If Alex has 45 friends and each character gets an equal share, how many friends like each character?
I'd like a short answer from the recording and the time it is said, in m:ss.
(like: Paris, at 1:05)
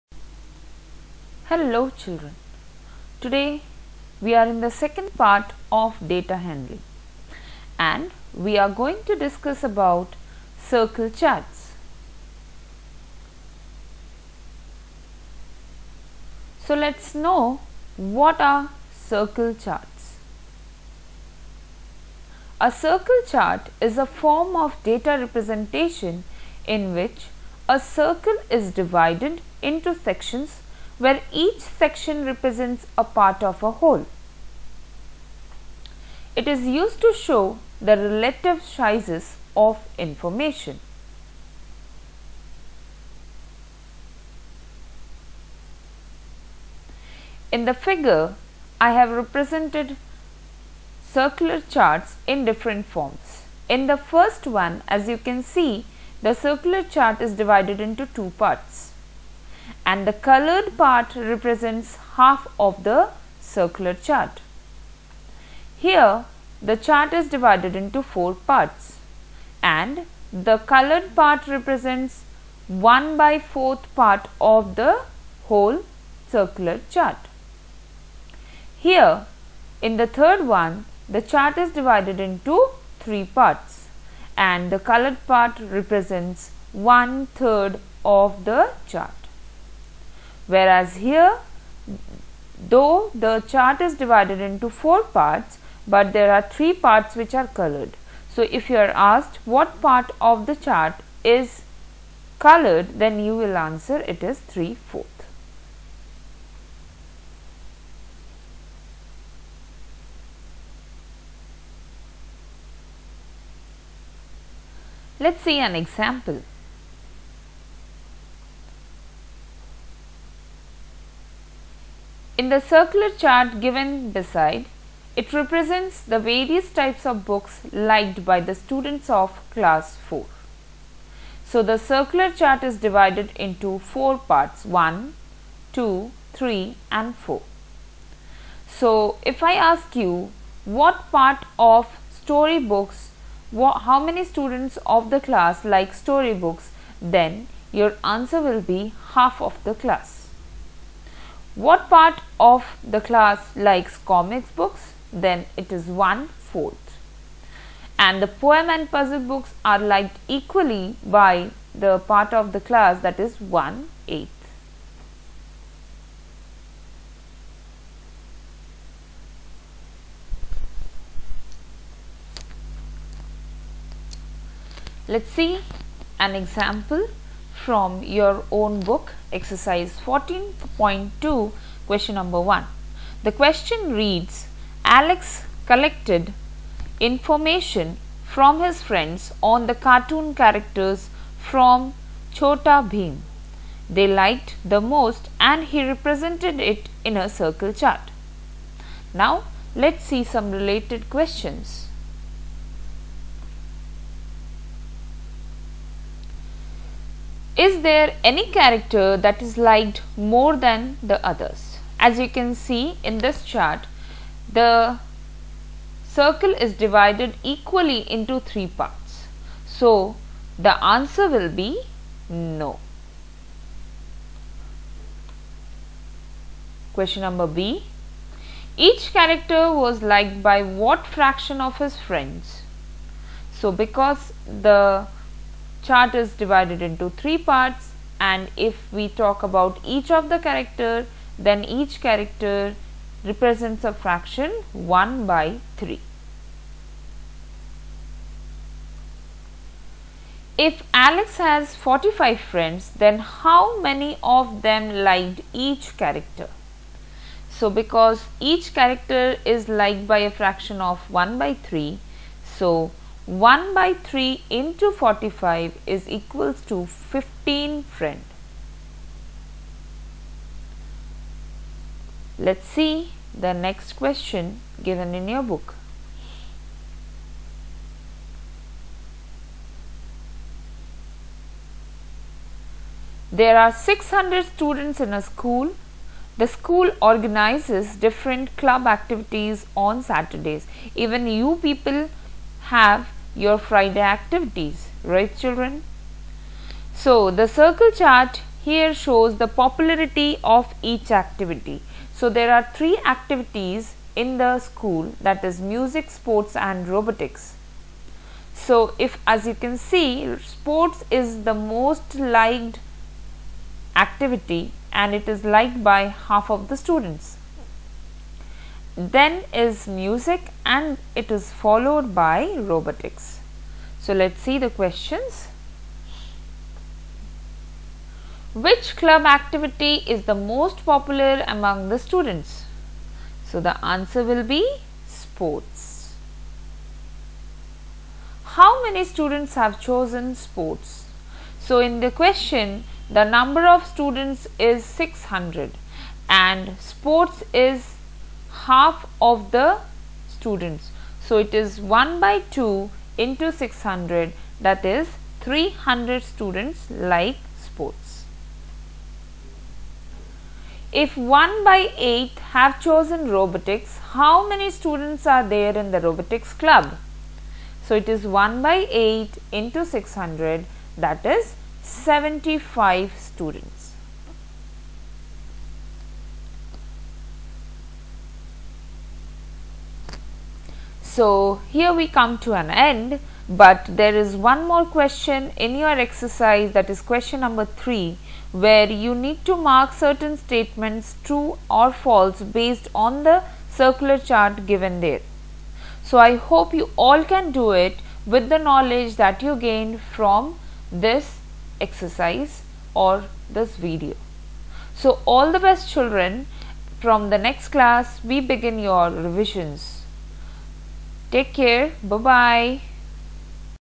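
15, at 4:26.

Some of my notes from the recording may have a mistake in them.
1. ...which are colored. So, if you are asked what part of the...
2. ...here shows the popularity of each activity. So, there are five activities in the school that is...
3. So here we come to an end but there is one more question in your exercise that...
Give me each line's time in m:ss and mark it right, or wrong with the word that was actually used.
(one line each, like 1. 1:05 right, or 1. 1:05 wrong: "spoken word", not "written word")
1. 1:37 right
2. 4:58 wrong: "three", not "five"
3. 6:21 right.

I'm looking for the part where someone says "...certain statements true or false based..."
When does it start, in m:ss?
6:29.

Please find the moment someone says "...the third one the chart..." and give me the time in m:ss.
1:19.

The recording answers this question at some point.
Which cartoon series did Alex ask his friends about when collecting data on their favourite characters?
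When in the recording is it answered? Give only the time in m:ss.
3:12.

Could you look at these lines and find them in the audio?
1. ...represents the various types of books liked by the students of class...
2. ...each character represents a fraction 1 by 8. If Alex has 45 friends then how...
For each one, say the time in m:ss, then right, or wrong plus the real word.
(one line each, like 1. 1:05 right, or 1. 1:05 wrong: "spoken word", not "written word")
1. 2:05 right
2. 4:01 wrong: "3", not "8".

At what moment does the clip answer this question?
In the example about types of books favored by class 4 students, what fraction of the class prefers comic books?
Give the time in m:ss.
2:35.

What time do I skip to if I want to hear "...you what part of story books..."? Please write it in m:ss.
2:19.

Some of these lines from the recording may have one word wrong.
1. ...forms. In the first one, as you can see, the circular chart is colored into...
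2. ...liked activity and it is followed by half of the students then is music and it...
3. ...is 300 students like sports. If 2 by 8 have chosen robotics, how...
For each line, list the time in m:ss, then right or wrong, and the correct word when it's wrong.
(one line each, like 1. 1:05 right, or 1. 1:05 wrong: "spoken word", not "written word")
1. 0:52 wrong: "divided", not "colored"
2. 5:12 wrong: "liked", not "followed"
3. 5:54 wrong: "1", not "2".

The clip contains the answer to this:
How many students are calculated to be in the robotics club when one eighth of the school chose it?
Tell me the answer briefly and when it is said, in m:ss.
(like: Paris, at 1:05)
75, at 6:11.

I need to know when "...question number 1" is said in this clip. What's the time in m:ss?
3:01.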